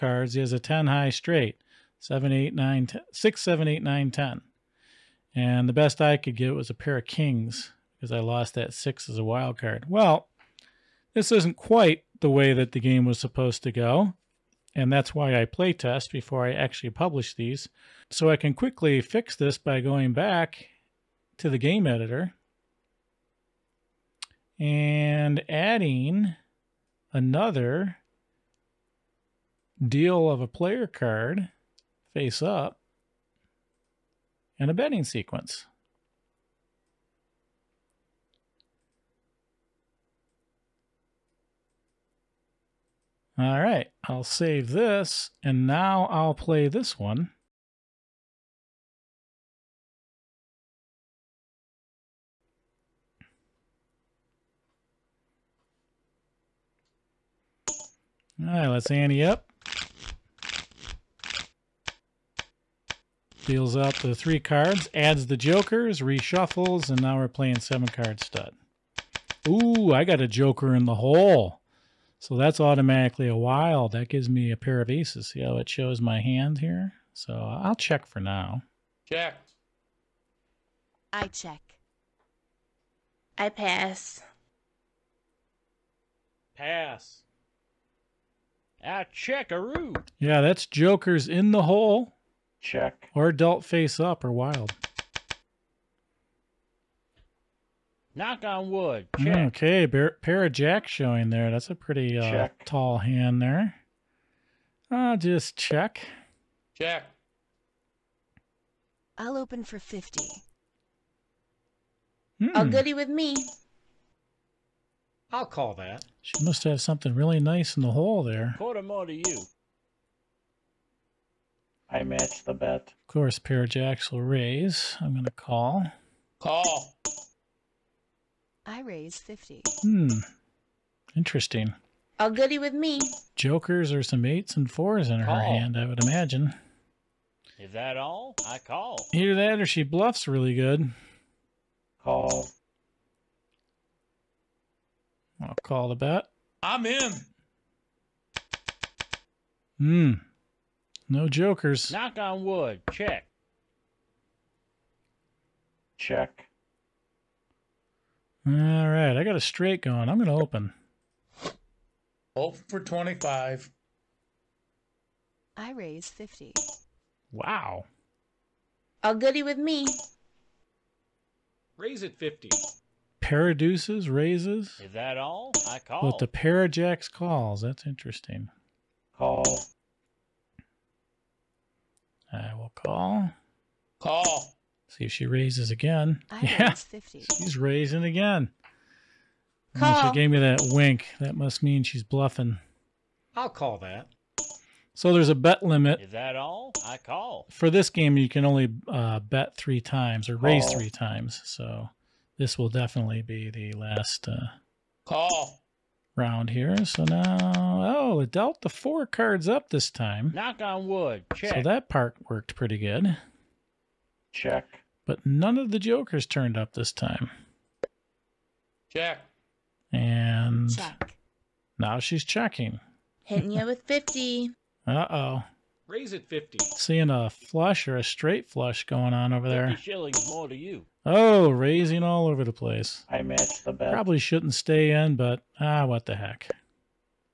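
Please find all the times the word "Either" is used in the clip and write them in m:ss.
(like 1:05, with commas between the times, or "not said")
2:19.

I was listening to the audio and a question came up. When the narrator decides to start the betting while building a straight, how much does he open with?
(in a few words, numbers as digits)
25.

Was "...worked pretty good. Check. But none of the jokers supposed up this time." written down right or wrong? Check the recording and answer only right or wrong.
wrong.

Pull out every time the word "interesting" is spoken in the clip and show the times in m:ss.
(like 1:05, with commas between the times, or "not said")
2:11, 2:57.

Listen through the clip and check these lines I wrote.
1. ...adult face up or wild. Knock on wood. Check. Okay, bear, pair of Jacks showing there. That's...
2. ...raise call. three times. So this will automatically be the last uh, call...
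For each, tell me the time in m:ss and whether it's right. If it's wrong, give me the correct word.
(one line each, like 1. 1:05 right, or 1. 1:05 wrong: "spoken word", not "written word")
1. 1:33 right
2. 3:20 wrong: "definitely", not "automatically".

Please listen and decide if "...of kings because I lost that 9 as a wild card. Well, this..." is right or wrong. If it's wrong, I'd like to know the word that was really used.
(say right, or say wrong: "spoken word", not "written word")
wrong: "6", not "9".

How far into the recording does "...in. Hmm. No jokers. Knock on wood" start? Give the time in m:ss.
2:26.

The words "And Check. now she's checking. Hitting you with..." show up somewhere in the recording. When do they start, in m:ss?
3:39.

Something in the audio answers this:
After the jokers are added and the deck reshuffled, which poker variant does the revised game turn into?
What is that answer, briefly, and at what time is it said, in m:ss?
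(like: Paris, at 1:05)
Seven card stud, at 1:07.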